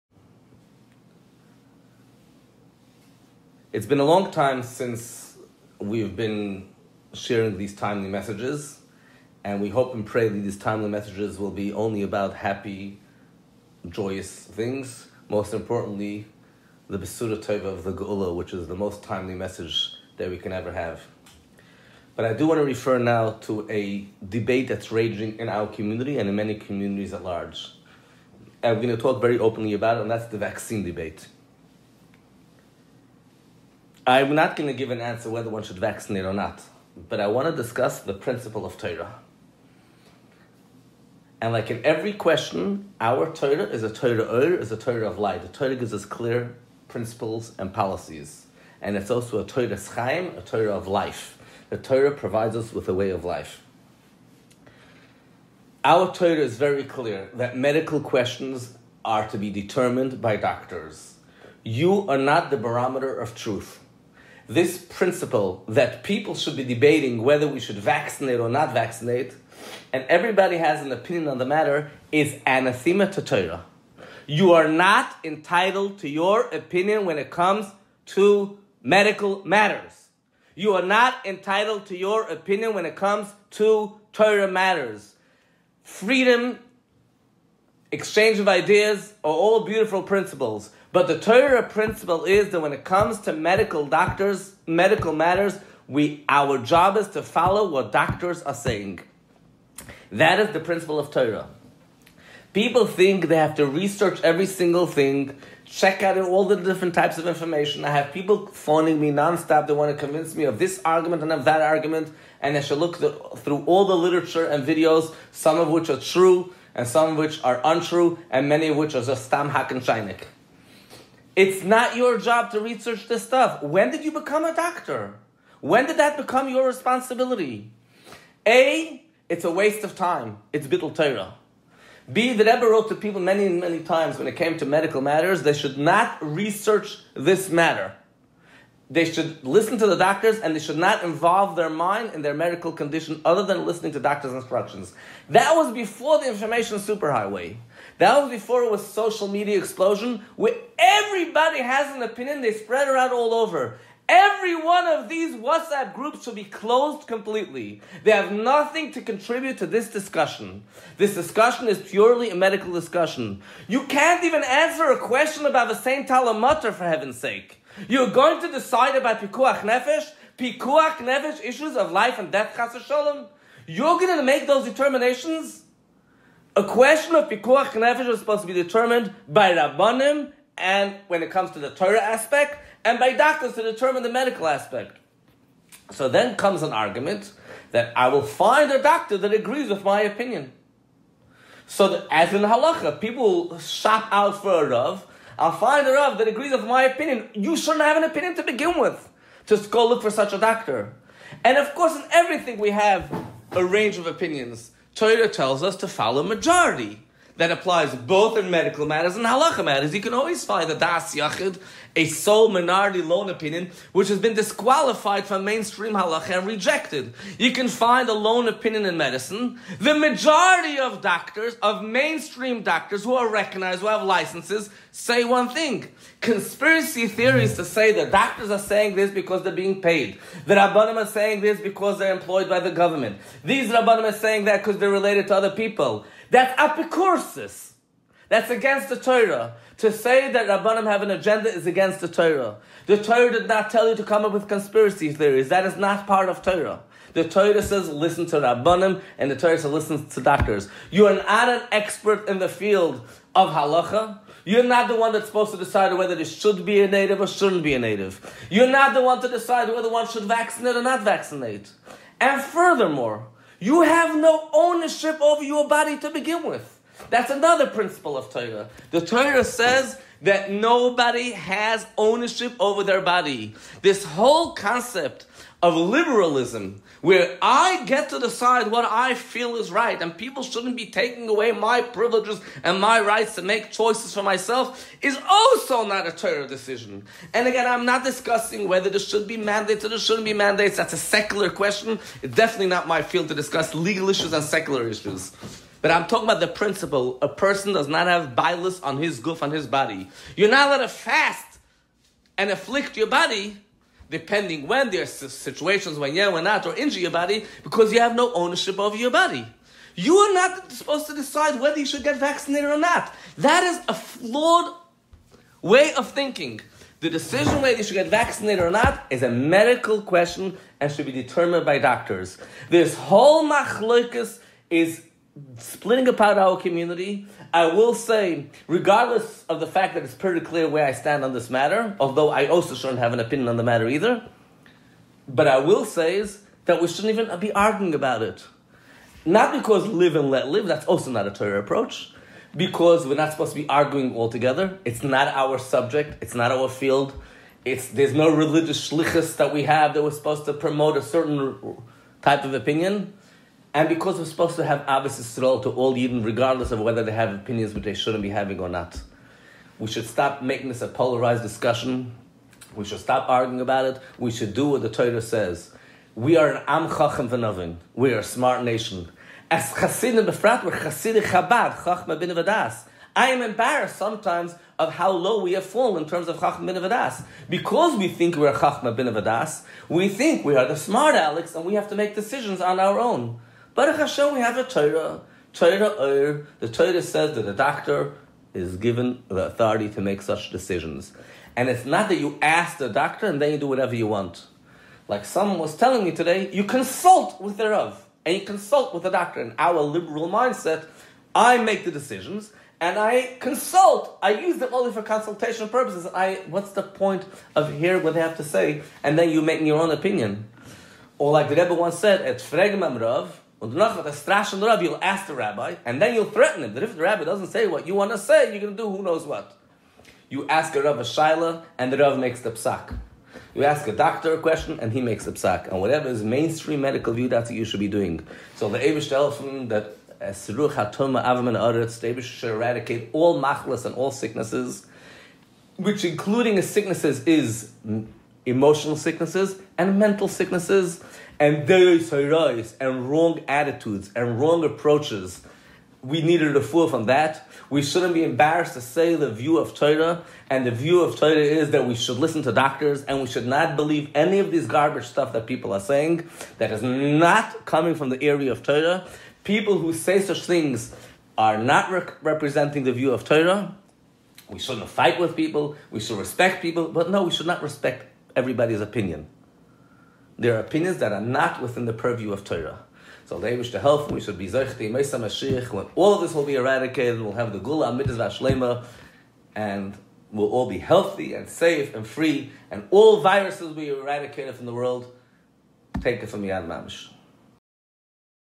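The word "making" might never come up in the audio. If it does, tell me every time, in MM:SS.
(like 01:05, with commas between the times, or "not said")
06:00, 06:49.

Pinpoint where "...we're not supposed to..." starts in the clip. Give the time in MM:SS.
05:43.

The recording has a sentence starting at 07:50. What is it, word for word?
There are opinions that are not within the purview of Torah.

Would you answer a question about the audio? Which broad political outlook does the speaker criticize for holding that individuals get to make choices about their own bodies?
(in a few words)
liberalism.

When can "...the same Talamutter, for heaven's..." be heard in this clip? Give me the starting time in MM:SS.
02:45.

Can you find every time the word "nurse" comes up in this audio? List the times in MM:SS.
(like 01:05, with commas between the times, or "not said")
not said.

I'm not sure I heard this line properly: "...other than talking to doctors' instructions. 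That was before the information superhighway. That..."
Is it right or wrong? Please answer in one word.
wrong.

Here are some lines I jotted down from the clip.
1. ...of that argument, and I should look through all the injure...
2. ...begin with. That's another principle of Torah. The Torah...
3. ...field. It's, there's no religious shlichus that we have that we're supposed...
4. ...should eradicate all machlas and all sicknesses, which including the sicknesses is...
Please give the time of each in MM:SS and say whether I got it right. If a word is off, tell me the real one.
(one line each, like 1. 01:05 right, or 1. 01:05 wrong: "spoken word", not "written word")
1. 01:51 wrong: "literature", not "injure"
2. 04:26 right
3. 05:46 right
4. 07:12 right.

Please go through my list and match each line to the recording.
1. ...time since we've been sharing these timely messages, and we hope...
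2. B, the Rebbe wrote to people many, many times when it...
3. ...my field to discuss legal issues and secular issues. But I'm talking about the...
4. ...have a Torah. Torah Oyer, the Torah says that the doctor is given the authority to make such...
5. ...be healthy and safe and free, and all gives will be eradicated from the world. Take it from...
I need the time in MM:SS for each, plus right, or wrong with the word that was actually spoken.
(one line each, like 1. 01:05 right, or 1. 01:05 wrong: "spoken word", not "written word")
1. 00:04 right
2. 02:12 right
3. 04:52 right
4. 06:24 right
5. 08:00 wrong: "viruses", not "gives".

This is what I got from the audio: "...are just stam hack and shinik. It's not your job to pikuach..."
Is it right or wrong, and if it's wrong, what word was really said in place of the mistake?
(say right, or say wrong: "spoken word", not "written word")
wrong: "research", not "pikuach".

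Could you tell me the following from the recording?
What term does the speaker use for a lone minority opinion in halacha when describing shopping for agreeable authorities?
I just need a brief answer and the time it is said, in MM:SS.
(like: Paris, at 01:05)
das yachid, at 03:30.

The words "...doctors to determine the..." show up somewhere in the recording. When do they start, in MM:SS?
03:03.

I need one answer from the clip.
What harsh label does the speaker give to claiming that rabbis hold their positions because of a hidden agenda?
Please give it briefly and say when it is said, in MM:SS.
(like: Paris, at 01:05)
apikursis, at 03:56.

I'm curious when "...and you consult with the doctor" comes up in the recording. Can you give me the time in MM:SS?
06:38.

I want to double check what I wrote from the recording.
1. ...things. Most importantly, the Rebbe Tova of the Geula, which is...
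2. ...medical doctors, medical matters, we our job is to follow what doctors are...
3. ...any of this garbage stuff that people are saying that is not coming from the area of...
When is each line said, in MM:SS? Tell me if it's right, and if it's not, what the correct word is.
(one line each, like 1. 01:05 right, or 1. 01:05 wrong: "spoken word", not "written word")
1. 00:14 wrong: "Besura", not "Rebbe"
2. 01:33 right
3. 07:34 right.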